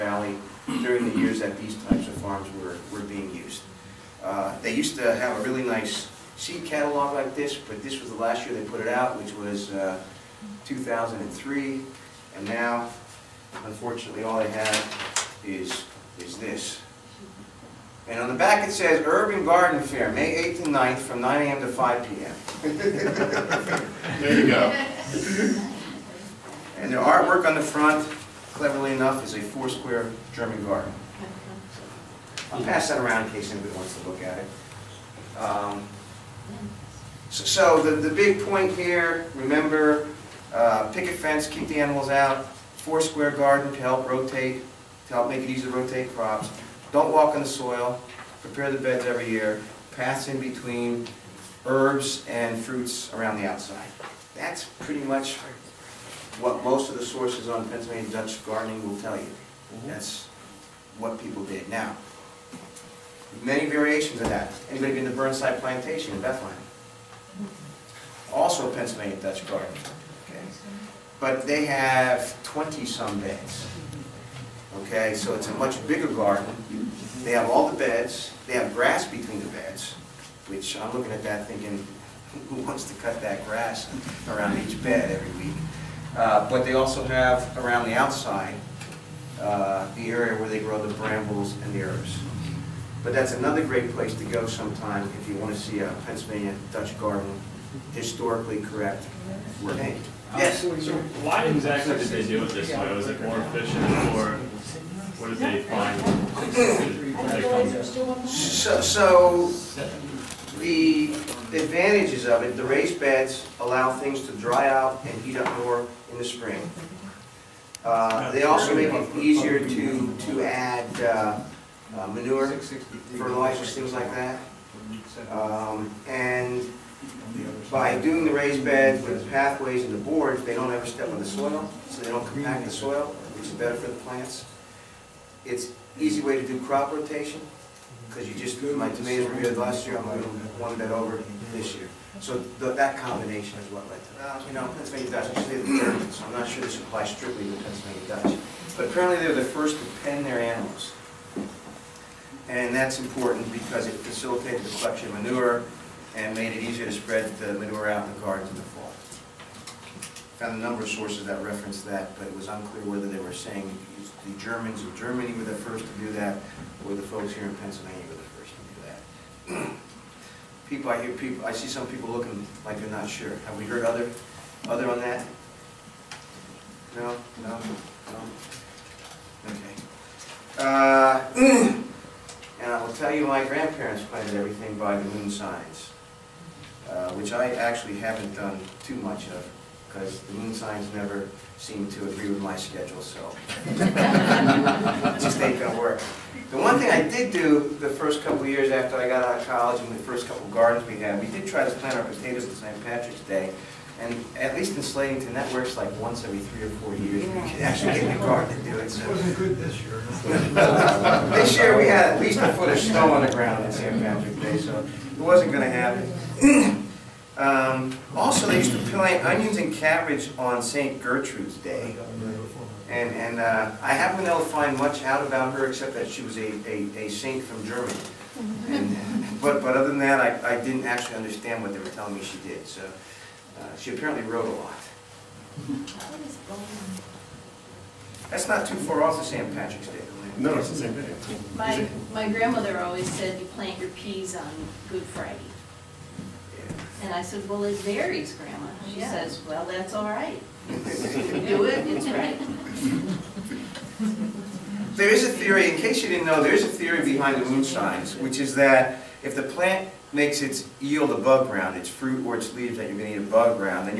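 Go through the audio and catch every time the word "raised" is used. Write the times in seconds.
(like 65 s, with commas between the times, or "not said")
112 s, 128 s.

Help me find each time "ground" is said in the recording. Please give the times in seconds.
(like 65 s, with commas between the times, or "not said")
213 s, 261 s.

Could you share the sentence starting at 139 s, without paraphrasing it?
I'm going to one bed over this year.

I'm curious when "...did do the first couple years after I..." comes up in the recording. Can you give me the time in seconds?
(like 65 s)
197 s.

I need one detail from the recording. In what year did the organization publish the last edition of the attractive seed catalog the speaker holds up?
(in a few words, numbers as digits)
2003.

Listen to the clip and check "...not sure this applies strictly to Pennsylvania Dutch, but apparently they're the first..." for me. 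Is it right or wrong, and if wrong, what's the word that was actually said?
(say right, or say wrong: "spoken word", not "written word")
right.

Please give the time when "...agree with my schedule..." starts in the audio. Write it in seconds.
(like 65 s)
192 s.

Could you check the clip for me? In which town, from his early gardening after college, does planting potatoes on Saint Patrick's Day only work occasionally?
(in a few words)
Slatington.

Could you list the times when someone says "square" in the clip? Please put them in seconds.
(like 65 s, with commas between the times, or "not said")
29 s, 42 s.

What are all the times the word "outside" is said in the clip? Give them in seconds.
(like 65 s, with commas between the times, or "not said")
53 s, 87 s.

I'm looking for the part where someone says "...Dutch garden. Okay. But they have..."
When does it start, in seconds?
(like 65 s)
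69 s.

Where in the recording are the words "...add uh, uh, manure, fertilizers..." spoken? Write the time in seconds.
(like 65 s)
120 s.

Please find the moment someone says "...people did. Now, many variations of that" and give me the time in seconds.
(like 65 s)
61 s.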